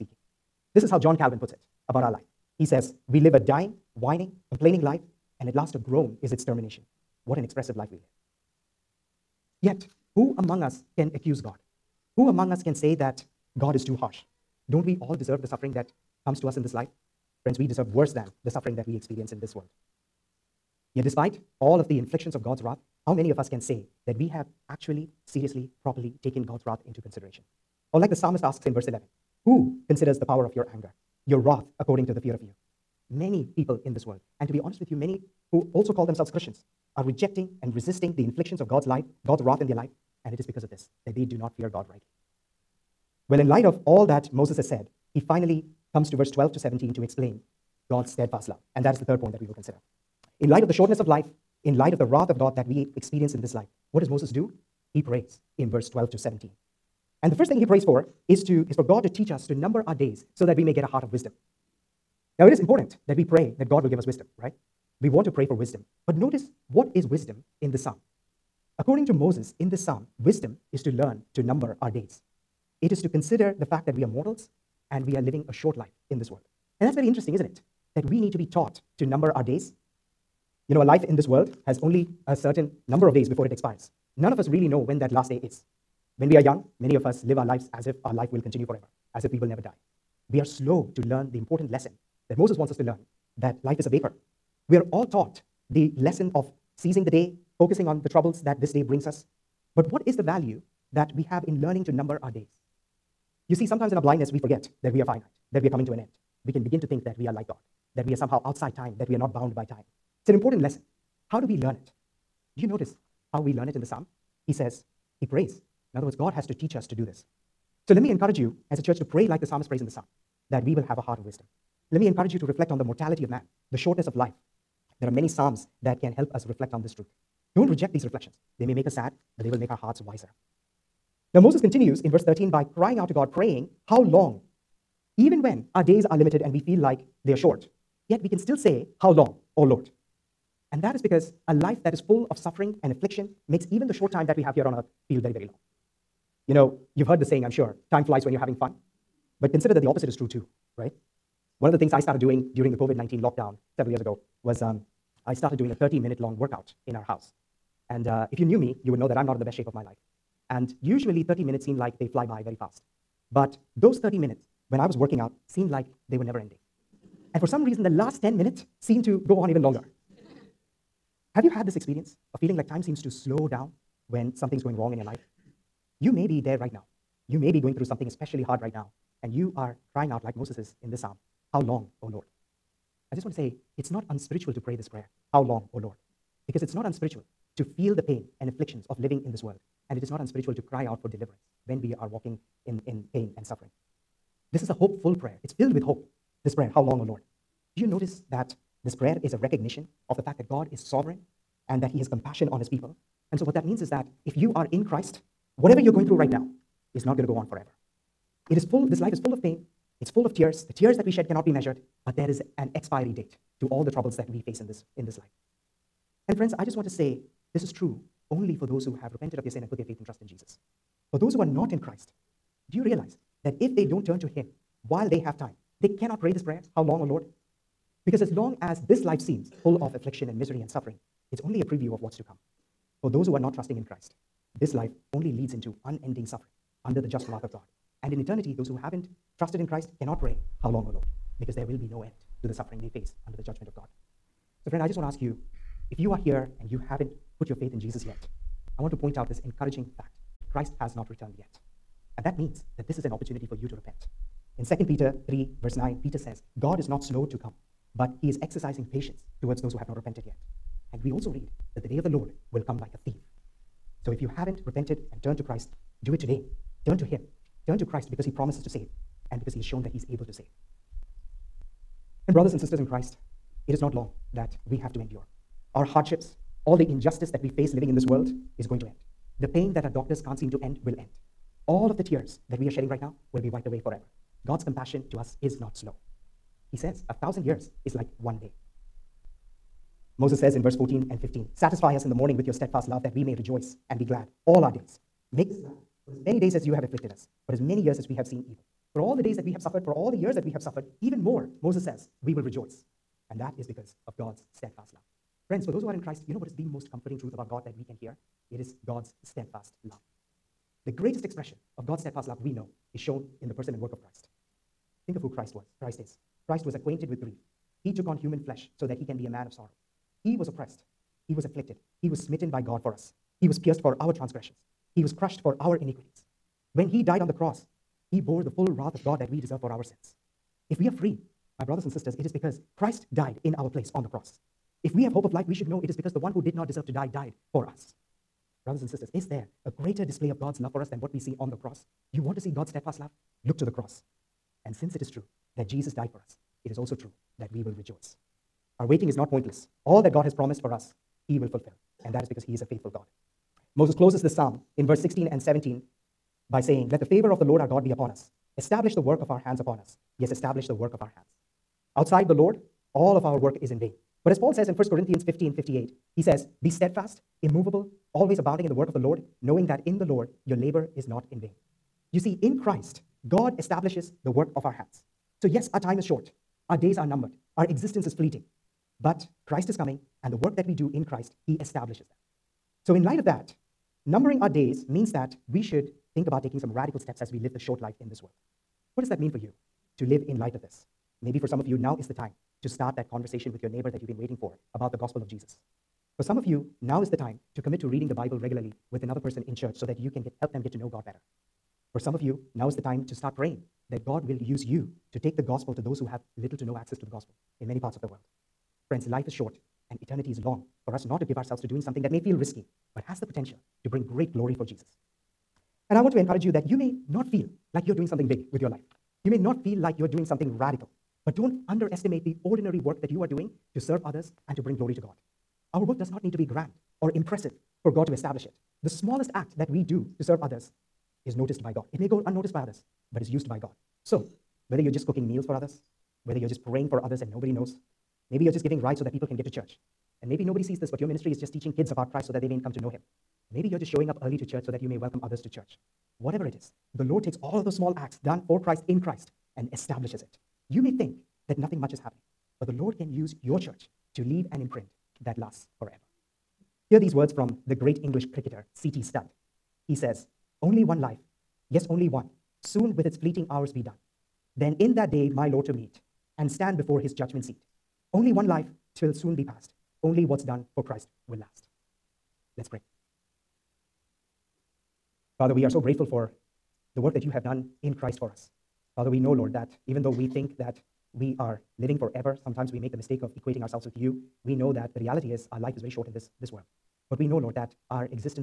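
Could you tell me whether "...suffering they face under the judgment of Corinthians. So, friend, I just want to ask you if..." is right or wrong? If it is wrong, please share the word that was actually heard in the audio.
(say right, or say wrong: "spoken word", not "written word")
wrong: "God", not "Corinthians".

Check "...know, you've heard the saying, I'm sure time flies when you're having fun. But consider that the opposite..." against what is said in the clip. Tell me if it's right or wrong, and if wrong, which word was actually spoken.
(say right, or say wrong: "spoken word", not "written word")
right.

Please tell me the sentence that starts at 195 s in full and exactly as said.
It's filled with hope, this prayer, How long, O Lord?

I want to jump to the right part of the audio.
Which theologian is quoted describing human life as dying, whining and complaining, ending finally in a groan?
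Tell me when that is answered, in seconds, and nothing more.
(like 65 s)
0 s.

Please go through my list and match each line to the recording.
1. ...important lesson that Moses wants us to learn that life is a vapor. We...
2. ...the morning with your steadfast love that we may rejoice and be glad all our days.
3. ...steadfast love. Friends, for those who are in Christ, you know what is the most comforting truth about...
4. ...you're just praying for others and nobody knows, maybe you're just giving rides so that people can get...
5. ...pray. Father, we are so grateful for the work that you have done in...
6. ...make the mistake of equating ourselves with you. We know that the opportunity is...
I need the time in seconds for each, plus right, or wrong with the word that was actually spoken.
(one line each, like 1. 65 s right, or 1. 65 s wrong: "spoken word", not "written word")
1. 91 s right
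2. 292 s right
3. 304 s right
4. 436 s right
5. 472 s right
6. 482 s wrong: "reality", not "opportunity".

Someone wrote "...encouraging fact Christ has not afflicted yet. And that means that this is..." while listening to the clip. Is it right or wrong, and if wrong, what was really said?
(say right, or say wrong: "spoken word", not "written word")
wrong: "returned", not "afflicted".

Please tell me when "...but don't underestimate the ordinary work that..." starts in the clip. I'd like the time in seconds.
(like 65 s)
421 s.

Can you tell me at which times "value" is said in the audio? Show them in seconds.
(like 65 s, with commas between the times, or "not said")
100 s.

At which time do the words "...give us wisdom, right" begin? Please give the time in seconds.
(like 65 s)
63 s.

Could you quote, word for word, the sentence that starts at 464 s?
Then in that day my Lord to meet and stand before his judgment seat.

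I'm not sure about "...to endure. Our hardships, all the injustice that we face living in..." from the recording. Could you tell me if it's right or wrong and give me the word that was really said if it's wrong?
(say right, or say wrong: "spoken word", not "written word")
right.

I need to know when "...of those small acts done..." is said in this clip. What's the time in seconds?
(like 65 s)
447 s.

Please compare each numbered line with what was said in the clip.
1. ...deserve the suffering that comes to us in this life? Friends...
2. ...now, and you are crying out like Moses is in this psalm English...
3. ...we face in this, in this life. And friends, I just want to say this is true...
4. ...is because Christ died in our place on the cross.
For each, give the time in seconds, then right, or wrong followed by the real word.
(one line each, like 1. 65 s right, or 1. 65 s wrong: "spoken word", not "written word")
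1. 15 s right
2. 178 s wrong: "How", not "English"
3. 214 s right
4. 332 s right.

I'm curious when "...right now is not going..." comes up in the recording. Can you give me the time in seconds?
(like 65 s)
206 s.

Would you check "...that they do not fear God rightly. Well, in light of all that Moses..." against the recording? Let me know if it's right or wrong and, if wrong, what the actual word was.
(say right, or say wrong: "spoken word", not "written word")
right.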